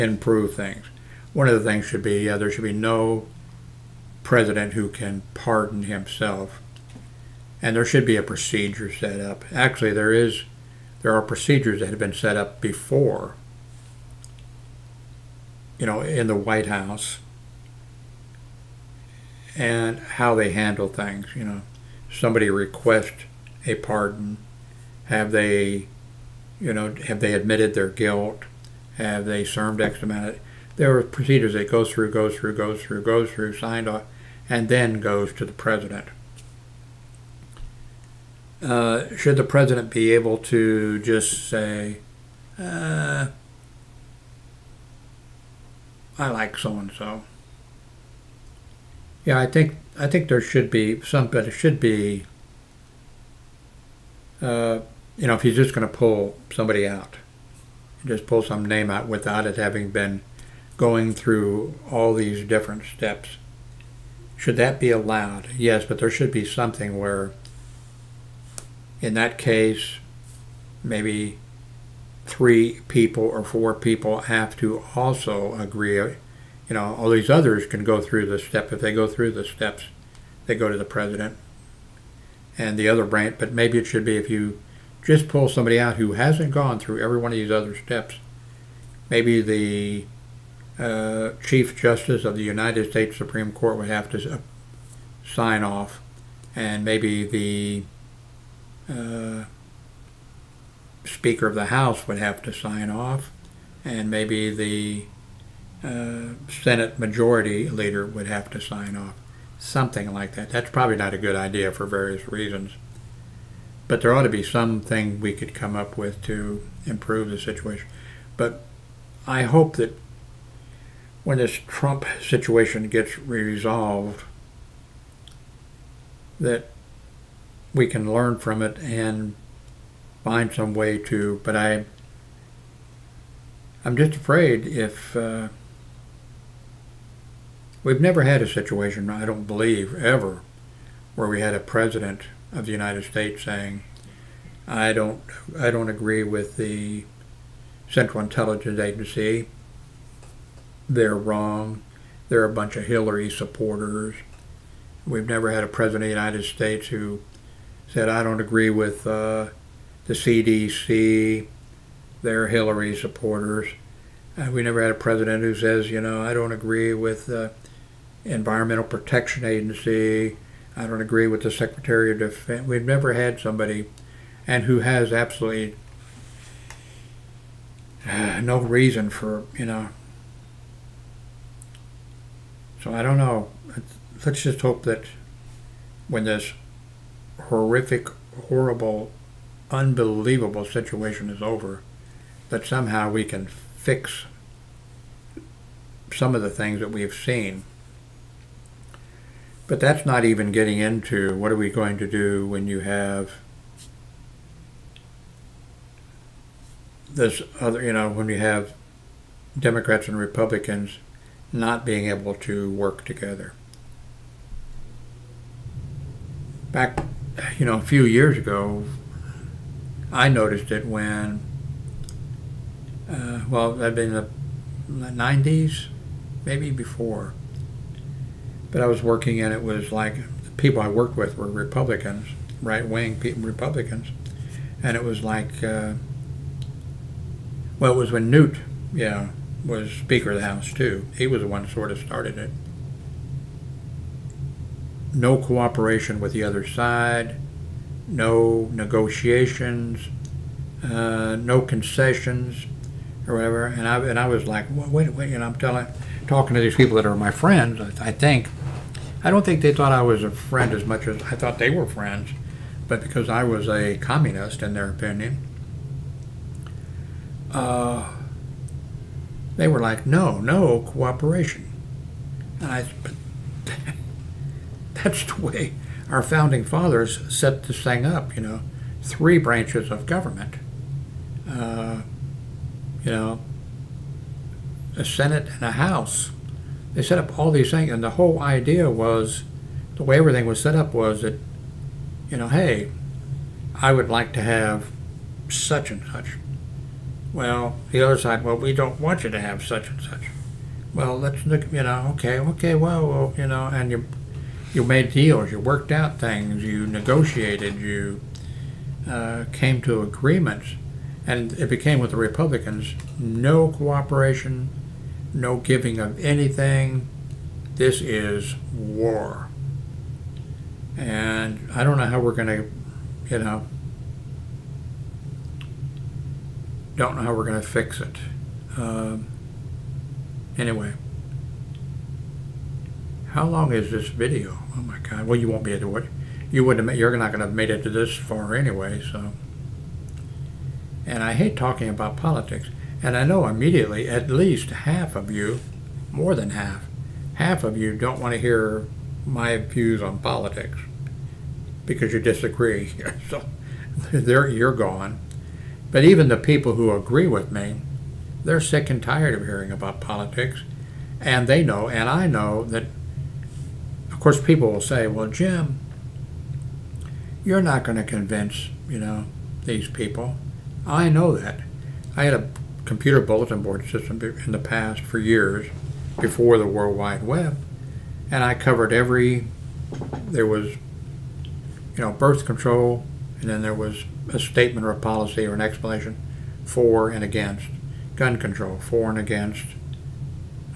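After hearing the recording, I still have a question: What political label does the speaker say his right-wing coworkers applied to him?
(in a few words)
communist.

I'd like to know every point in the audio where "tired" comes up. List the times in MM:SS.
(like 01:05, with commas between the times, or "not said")
05:59.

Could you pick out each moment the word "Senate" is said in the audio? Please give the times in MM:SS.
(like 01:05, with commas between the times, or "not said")
01:46, 04:45.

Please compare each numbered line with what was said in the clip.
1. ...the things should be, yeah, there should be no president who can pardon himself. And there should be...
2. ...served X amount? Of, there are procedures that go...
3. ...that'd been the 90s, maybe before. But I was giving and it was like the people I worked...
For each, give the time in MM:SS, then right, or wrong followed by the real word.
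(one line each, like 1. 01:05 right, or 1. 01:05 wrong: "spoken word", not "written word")
1. 00:01 right
2. 00:29 right
3. 03:43 wrong: "working", not "giving".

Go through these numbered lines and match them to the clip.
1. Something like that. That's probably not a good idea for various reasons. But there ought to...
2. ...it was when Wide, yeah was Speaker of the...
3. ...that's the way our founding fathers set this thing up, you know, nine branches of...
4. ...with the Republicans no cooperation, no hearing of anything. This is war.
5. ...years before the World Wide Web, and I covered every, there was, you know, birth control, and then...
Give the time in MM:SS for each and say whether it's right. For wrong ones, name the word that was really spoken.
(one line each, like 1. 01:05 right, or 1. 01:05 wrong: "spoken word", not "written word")
1. 01:49 right
2. 03:57 wrong: "Newt", not "Wide"
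3. 04:35 wrong: "three", not "nine"
4. 05:11 wrong: "giving", not "hearing"
5. 06:15 right.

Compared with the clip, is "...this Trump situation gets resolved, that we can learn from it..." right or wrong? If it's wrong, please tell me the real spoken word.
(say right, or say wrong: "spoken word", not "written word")
right.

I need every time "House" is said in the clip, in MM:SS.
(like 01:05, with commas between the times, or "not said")
00:16, 01:41, 04:00, 04:45.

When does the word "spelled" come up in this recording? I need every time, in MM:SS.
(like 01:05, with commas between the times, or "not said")
not said.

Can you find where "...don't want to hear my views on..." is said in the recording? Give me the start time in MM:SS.
05:47.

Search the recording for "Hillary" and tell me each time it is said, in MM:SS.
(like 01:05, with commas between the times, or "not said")
02:32, 02:42.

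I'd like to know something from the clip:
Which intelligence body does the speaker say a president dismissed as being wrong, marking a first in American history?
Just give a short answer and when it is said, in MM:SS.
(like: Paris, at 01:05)
Central Intelligence Agency, at 02:27.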